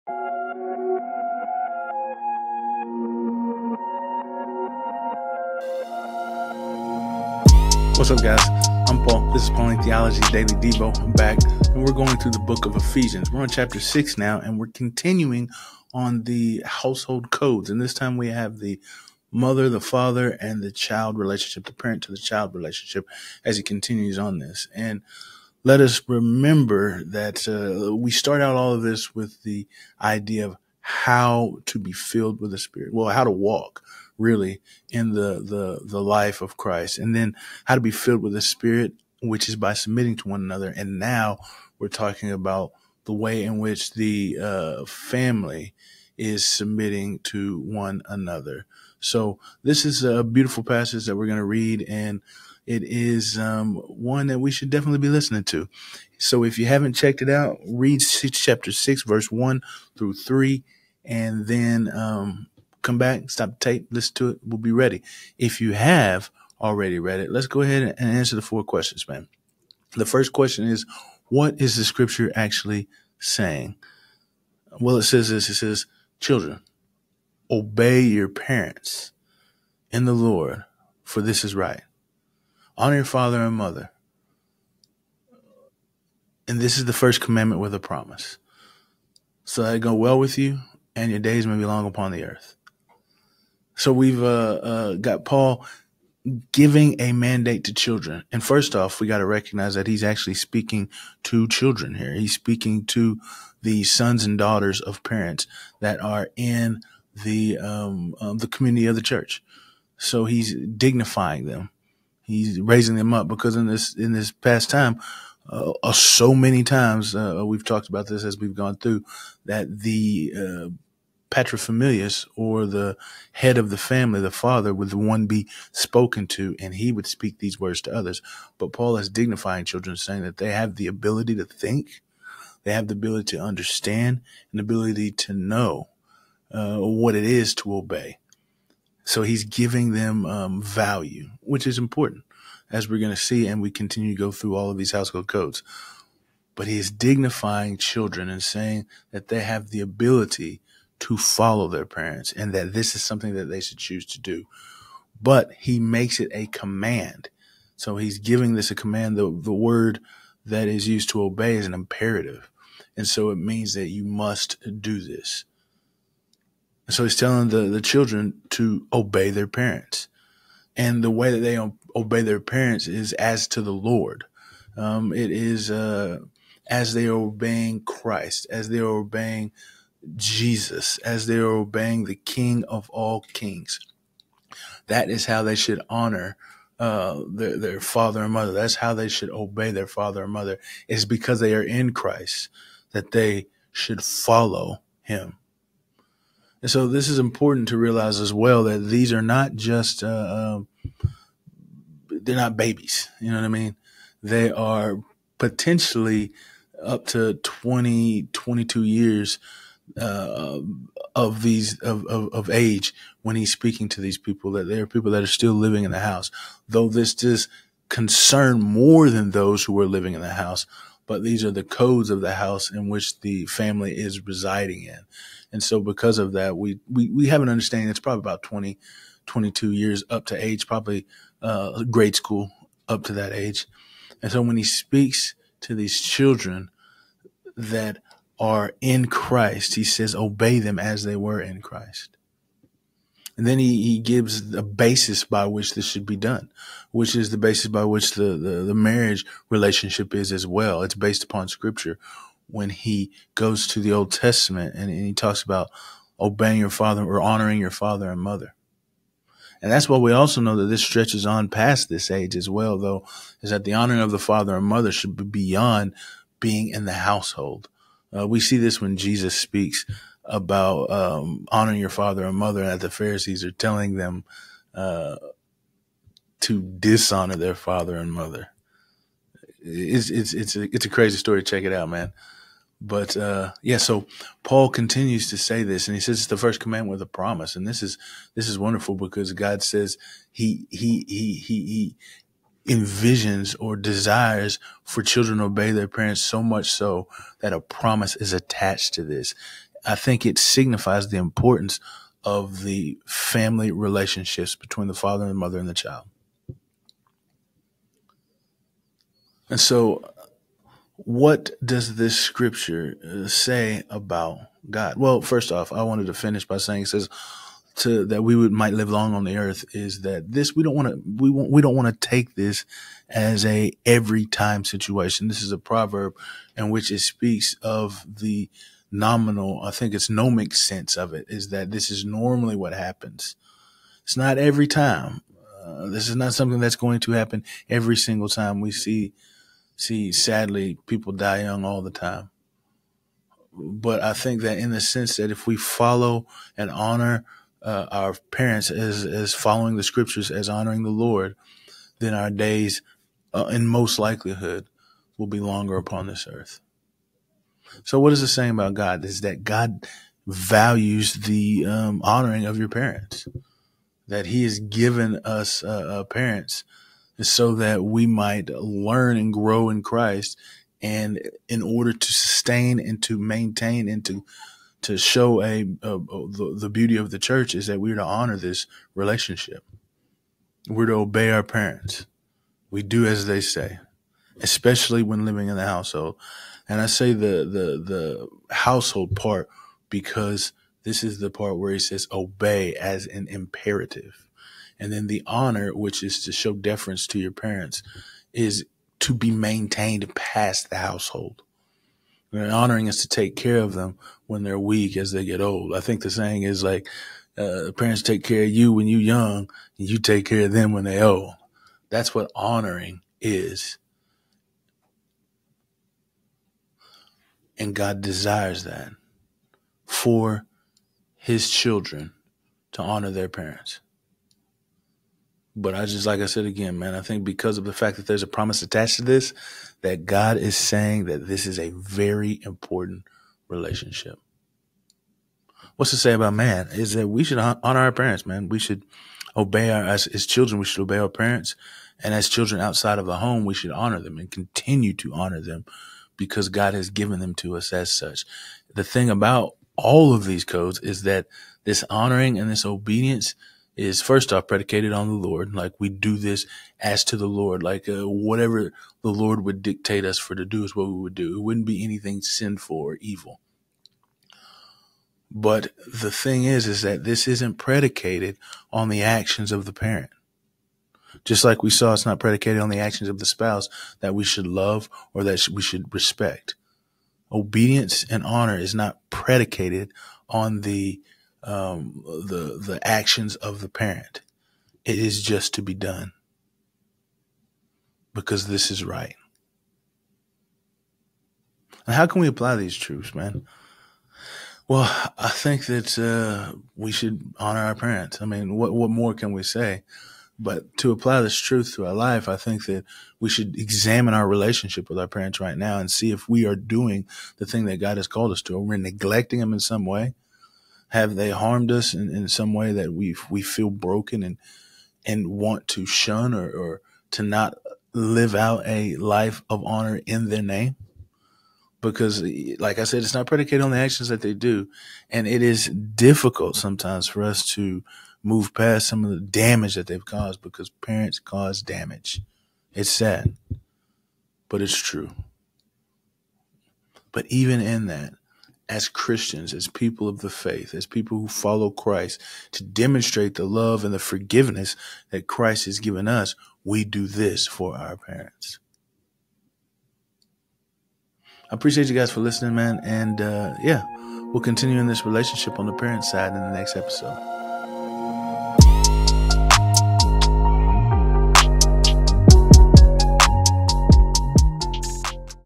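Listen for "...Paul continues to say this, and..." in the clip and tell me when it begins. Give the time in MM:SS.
04:44.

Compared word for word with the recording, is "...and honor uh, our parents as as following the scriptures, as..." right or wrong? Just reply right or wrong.
right.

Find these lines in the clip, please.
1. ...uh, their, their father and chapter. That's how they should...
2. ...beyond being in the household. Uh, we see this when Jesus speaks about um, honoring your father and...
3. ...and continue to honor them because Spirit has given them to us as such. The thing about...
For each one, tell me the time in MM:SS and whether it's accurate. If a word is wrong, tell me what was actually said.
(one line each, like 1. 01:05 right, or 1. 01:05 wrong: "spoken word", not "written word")
1. 03:06 wrong: "mother", not "chapter"
2. 04:25 right
3. 07:24 wrong: "God", not "Spirit".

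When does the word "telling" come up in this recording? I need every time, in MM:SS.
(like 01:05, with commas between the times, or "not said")
02:47, 04:33.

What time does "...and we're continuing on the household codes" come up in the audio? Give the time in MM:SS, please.
00:14.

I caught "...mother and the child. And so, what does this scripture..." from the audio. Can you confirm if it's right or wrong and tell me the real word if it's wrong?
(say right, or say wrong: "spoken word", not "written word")
right.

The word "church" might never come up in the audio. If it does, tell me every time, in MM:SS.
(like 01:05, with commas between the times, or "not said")
01:49, 06:17.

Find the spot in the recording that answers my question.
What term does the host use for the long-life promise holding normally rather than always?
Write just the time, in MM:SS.
05:30.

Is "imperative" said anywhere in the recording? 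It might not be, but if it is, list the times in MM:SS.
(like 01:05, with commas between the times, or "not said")
02:41, 06:33.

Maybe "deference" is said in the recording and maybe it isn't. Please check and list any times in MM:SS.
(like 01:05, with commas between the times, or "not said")
06:36.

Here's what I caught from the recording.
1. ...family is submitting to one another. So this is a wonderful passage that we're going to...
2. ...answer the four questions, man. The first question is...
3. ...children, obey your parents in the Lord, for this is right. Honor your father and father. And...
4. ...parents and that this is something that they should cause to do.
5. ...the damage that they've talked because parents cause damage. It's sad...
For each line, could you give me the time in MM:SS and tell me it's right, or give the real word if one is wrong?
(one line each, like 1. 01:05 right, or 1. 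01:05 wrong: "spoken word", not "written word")
1. 00:44 wrong: "beautiful", not "wonderful"
2. 01:08 right
3. 01:16 wrong: "mother", not "father"
4. 02:31 wrong: "choose", not "cause"
5. 08:49 wrong: "caused", not "talked".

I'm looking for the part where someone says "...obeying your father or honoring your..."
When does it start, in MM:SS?
04:16.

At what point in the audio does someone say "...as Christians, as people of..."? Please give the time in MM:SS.
08:58.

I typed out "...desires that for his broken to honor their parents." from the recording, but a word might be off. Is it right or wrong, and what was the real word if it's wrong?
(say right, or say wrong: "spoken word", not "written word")
wrong: "children", not "broken".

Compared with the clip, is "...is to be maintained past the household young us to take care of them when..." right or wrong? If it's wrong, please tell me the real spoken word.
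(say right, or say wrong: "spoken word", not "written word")
wrong: "honoring", not "young".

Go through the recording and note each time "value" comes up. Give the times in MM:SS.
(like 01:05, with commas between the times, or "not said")
02:20, 06:00.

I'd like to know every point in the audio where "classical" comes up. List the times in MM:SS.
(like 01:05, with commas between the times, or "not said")
not said.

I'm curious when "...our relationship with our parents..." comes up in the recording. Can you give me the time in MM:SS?
08:24.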